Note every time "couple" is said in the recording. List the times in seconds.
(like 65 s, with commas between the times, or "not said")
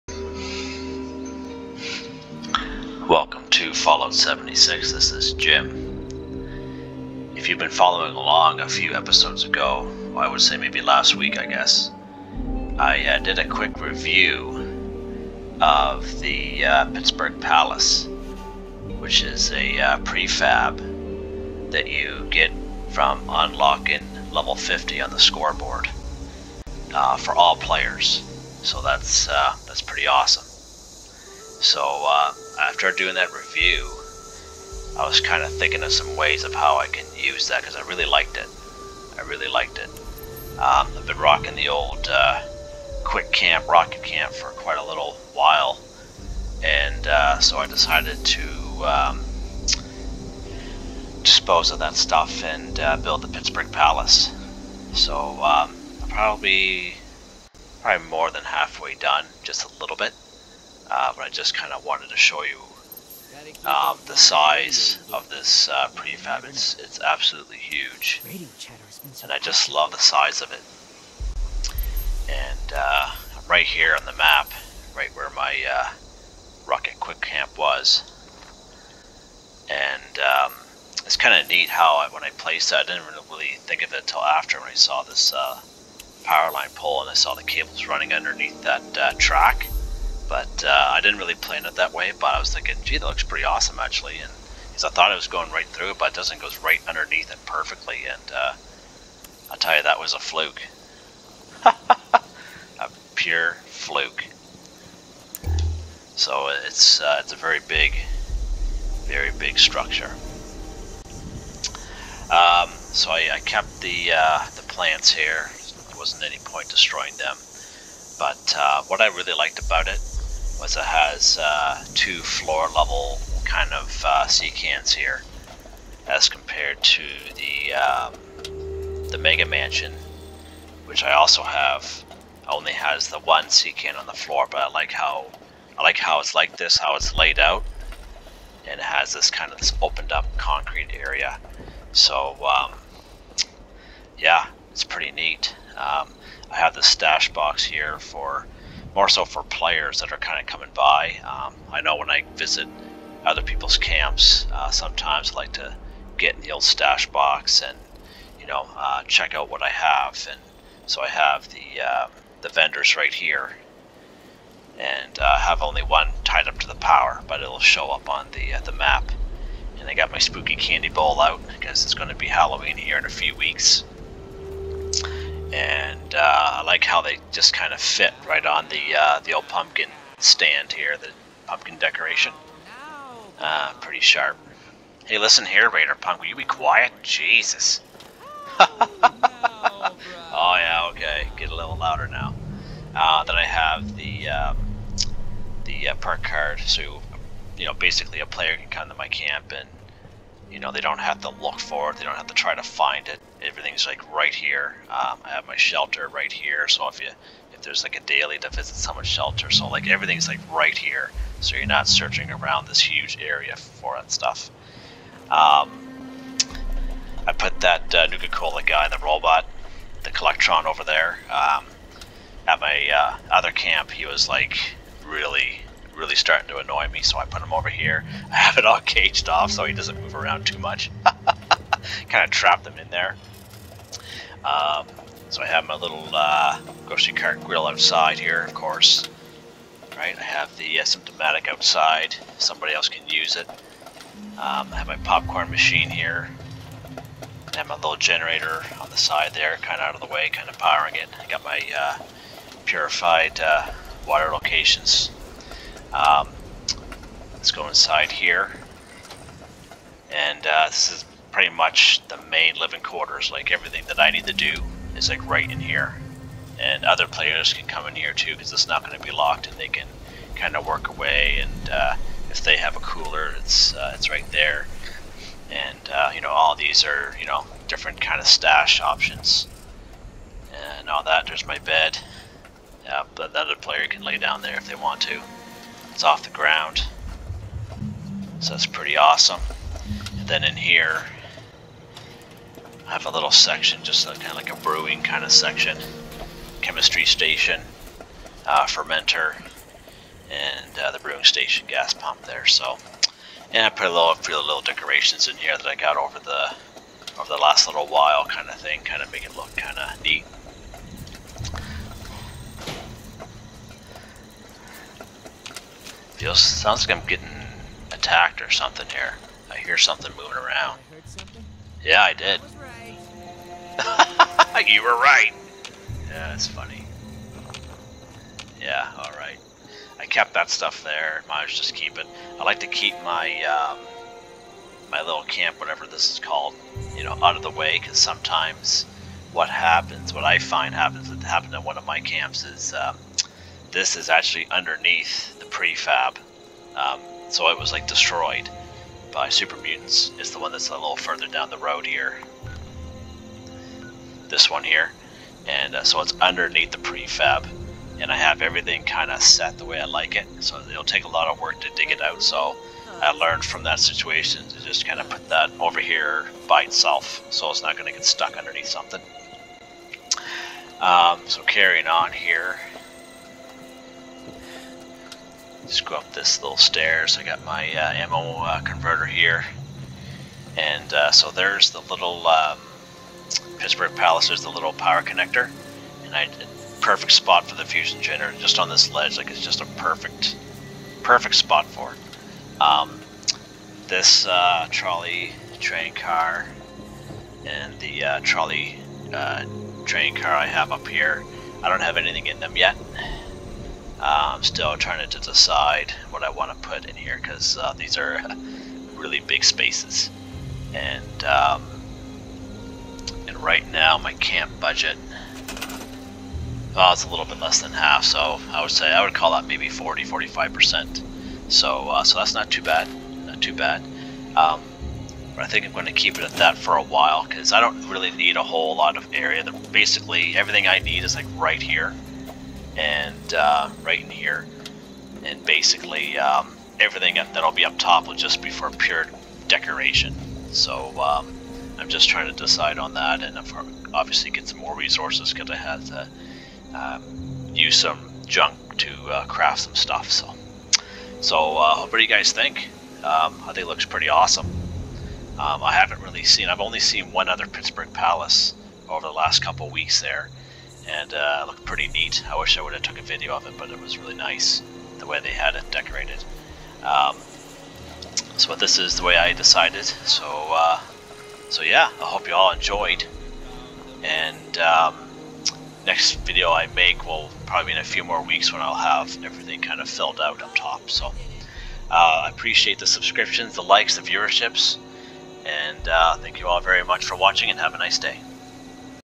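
459 s.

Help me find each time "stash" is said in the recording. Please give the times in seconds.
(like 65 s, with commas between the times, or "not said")
146 s, 156 s, 278 s.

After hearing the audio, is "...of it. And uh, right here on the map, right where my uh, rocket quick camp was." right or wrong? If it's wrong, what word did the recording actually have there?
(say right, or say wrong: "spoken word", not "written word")
right.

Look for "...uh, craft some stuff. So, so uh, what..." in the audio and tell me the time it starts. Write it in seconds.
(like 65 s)
449 s.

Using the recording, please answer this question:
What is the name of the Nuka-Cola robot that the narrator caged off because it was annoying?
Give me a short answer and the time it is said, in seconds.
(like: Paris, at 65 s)
Collectron, at 220 s.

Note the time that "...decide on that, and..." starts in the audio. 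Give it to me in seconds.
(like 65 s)
442 s.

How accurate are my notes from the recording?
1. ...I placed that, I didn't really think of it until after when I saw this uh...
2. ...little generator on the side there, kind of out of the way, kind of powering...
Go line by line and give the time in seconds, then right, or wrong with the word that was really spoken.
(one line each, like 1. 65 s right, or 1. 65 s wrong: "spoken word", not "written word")
1. 82 s right
2. 247 s right.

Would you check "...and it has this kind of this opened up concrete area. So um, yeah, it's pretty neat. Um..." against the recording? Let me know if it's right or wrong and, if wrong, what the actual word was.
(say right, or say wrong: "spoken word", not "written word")
right.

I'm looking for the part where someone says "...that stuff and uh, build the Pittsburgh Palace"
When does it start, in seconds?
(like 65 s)
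51 s.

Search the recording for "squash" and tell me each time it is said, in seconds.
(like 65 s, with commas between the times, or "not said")
not said.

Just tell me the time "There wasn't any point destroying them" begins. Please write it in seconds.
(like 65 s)
115 s.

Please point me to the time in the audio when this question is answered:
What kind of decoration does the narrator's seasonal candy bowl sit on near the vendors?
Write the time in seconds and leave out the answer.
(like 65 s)
179 s.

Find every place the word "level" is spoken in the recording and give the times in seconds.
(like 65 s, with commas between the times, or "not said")
24 s, 122 s.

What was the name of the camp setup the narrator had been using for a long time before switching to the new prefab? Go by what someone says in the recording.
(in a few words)
Quick Camp Rocket Camp.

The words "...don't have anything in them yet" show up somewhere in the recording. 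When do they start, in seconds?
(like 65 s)
401 s.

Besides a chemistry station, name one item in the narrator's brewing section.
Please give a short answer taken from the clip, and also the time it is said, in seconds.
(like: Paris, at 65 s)
fermenter, at 298 s.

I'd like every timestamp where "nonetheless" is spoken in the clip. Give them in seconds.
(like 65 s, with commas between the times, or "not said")
not said.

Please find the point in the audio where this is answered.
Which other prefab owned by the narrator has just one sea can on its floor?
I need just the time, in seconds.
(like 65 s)
129 s.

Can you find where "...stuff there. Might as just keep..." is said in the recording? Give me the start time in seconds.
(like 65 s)
330 s.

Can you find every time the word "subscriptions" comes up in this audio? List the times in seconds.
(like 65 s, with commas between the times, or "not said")
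482 s.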